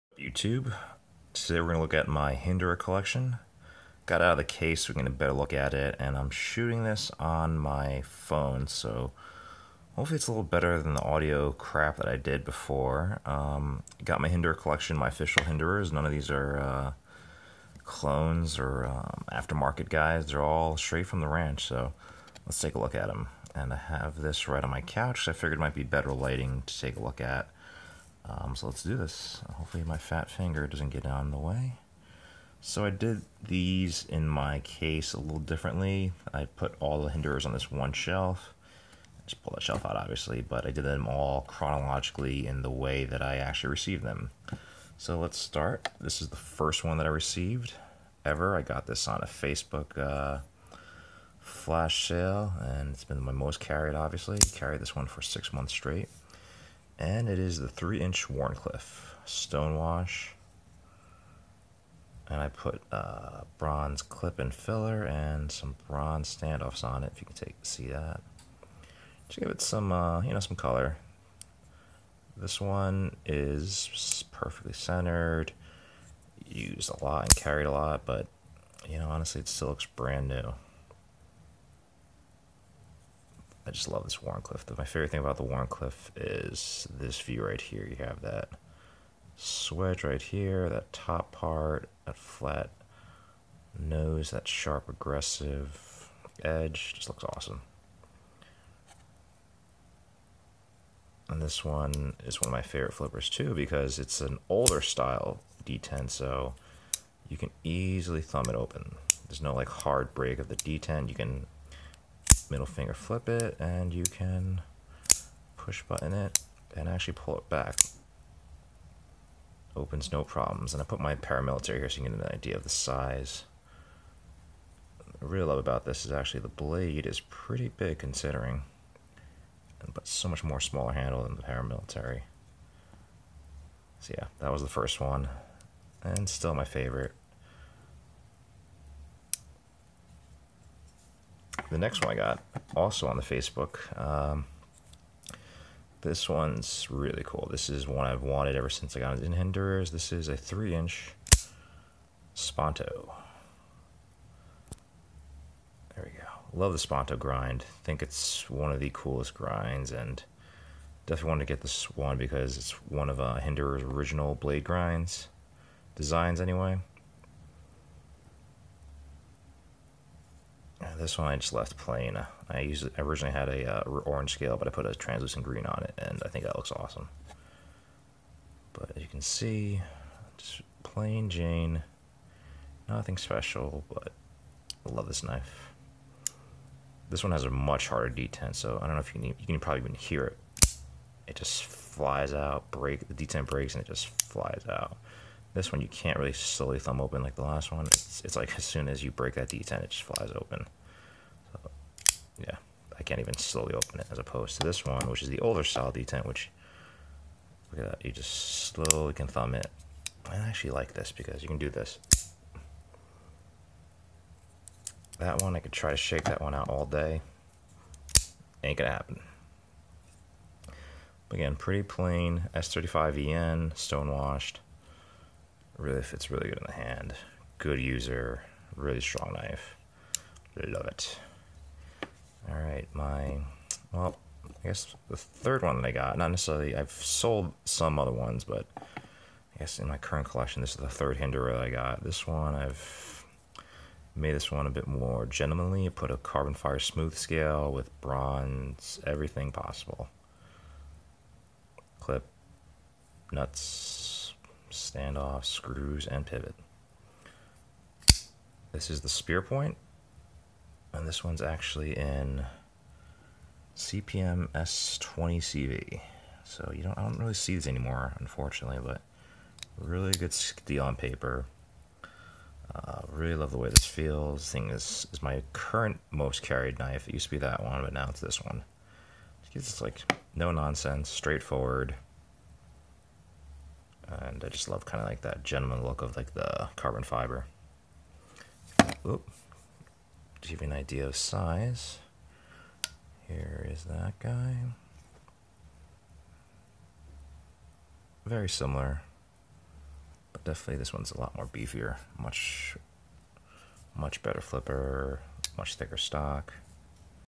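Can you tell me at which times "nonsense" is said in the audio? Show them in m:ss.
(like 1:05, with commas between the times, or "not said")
4:40.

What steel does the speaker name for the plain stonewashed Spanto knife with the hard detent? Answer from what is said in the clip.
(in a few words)
S35VN.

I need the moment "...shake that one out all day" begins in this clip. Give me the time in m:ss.
3:35.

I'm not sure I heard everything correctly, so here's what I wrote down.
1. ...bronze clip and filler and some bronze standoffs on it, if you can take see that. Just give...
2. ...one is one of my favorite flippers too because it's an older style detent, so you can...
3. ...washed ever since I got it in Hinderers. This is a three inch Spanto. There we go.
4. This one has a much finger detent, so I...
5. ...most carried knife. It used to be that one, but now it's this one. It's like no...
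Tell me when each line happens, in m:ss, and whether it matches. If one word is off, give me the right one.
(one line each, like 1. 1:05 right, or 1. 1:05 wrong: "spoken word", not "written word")
1. 1:03 right
2. 1:41 right
3. 2:28 wrong: "wanted", not "washed"
4. 3:07 wrong: "harder", not "finger"
5. 4:36 right.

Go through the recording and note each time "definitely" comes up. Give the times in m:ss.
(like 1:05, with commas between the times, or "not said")
2:41, 5:00.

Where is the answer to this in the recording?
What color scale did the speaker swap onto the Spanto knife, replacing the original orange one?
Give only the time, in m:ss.
2:54.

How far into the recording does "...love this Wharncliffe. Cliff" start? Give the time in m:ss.
1:23.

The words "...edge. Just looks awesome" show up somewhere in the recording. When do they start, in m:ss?
1:36.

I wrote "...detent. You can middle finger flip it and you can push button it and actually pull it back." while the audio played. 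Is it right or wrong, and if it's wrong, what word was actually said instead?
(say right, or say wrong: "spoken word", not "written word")
right.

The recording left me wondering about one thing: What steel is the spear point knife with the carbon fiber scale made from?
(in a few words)
CPM S20CV.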